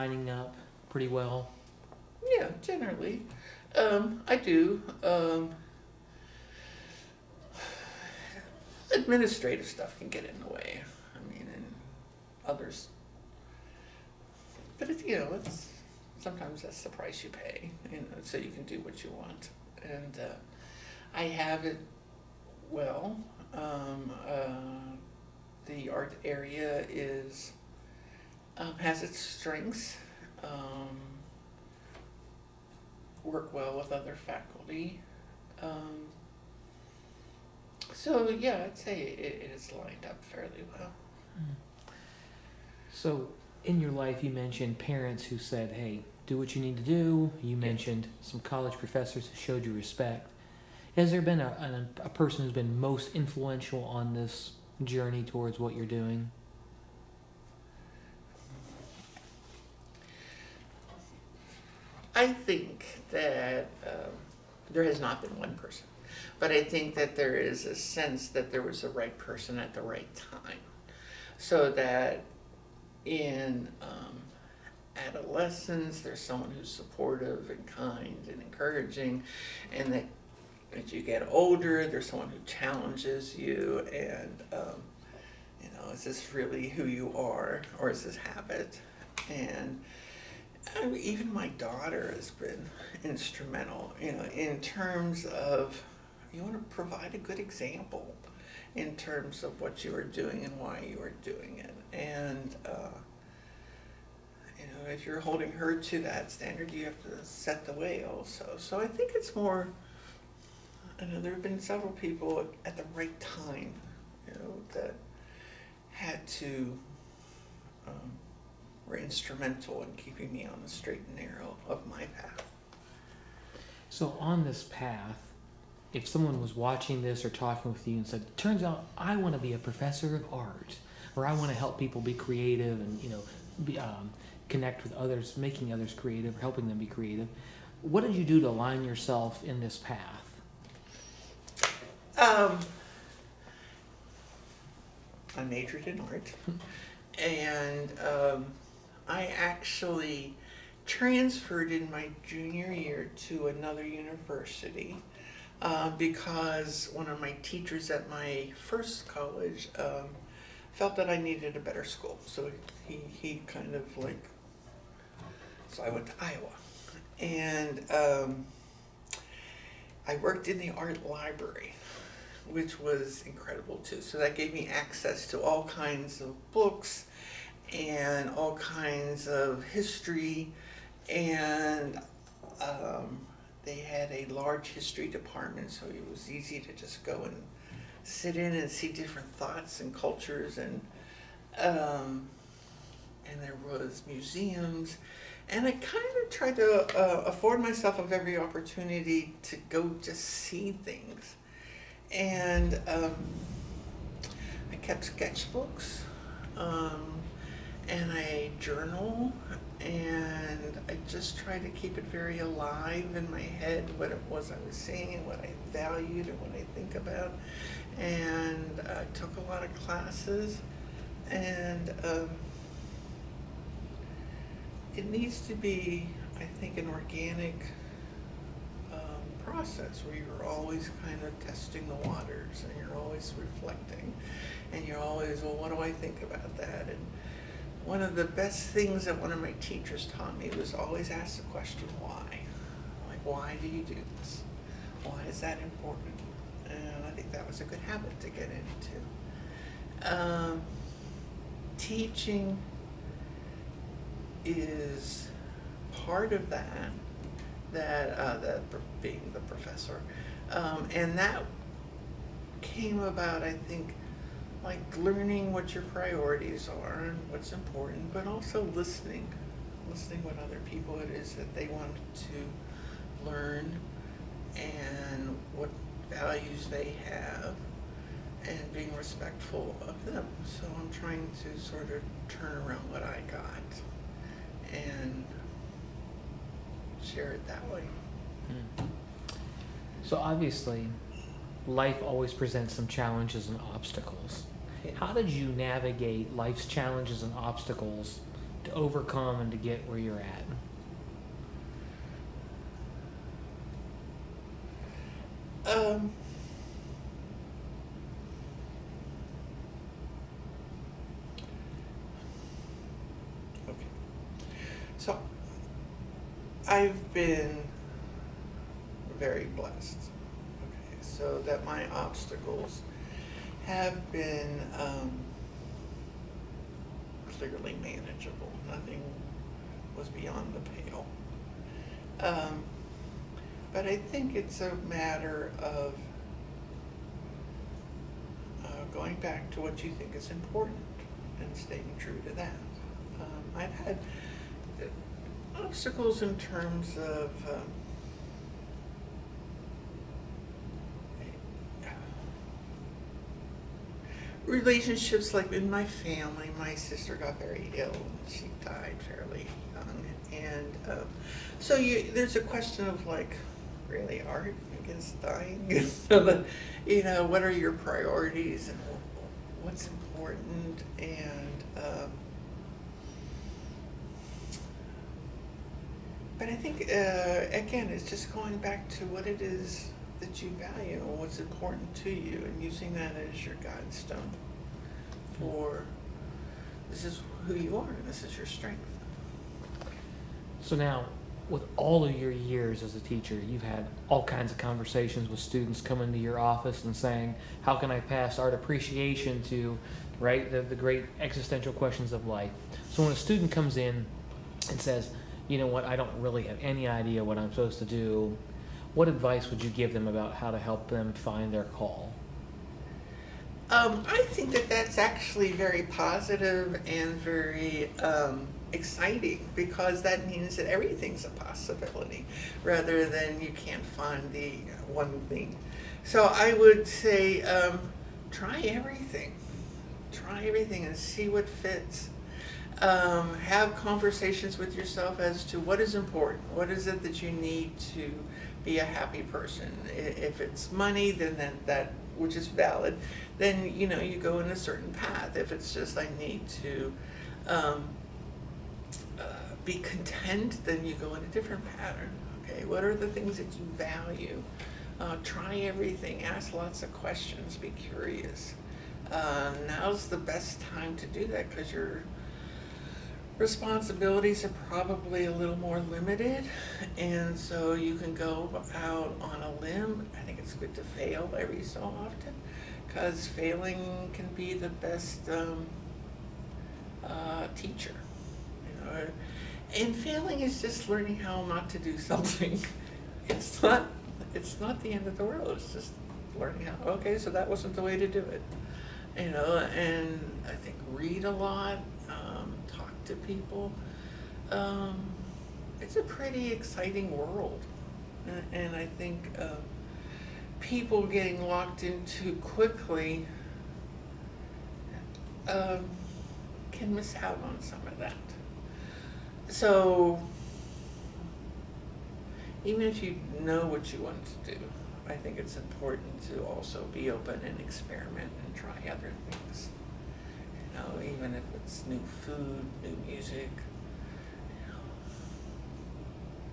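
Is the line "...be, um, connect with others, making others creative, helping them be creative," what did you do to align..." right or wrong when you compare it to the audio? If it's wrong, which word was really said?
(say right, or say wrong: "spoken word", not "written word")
right.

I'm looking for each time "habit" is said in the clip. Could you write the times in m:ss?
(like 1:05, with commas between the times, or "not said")
1:28, 4:07.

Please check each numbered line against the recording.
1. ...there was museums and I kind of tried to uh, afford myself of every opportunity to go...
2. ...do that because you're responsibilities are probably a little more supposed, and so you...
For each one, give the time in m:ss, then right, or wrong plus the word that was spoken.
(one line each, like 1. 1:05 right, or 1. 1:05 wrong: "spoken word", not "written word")
1. 3:13 right
2. 7:41 wrong: "limited", not "supposed".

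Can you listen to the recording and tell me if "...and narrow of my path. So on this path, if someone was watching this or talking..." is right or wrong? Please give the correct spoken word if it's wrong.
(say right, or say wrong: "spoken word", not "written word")
right.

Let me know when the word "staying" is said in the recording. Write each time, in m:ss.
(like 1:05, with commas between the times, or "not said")
5:41.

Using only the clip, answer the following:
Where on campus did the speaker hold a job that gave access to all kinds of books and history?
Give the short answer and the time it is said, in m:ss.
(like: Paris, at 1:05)
The art library, at 2:50.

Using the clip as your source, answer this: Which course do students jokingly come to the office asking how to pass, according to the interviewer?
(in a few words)
Art appreciation.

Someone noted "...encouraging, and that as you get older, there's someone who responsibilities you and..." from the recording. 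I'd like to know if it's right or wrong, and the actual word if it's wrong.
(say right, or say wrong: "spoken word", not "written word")
wrong: "challenges", not "responsibilities".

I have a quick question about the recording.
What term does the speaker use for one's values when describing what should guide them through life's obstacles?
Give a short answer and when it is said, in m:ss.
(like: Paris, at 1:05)
Guide stone, at 6:23.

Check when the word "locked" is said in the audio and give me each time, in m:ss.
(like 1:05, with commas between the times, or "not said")
8:21.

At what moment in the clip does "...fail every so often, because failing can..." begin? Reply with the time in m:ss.
7:50.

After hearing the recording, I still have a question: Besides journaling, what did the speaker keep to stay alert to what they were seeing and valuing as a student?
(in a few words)
Sketchbooks.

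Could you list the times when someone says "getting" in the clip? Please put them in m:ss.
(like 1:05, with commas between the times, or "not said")
8:21.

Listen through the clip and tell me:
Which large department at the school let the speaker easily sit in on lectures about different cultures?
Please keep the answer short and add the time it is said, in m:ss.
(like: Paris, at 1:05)
History department, at 3:04.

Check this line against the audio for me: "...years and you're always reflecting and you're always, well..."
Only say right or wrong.
wrong.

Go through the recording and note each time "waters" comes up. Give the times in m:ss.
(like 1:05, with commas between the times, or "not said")
3:52.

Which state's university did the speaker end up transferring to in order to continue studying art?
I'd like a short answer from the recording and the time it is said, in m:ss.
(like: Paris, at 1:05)
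Iowa, at 2:46.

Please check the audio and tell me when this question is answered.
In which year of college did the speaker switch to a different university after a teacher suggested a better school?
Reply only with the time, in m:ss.
2:32.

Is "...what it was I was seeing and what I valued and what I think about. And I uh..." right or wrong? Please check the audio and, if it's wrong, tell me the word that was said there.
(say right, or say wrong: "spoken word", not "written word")
right.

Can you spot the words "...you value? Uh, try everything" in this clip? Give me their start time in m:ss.
7:33.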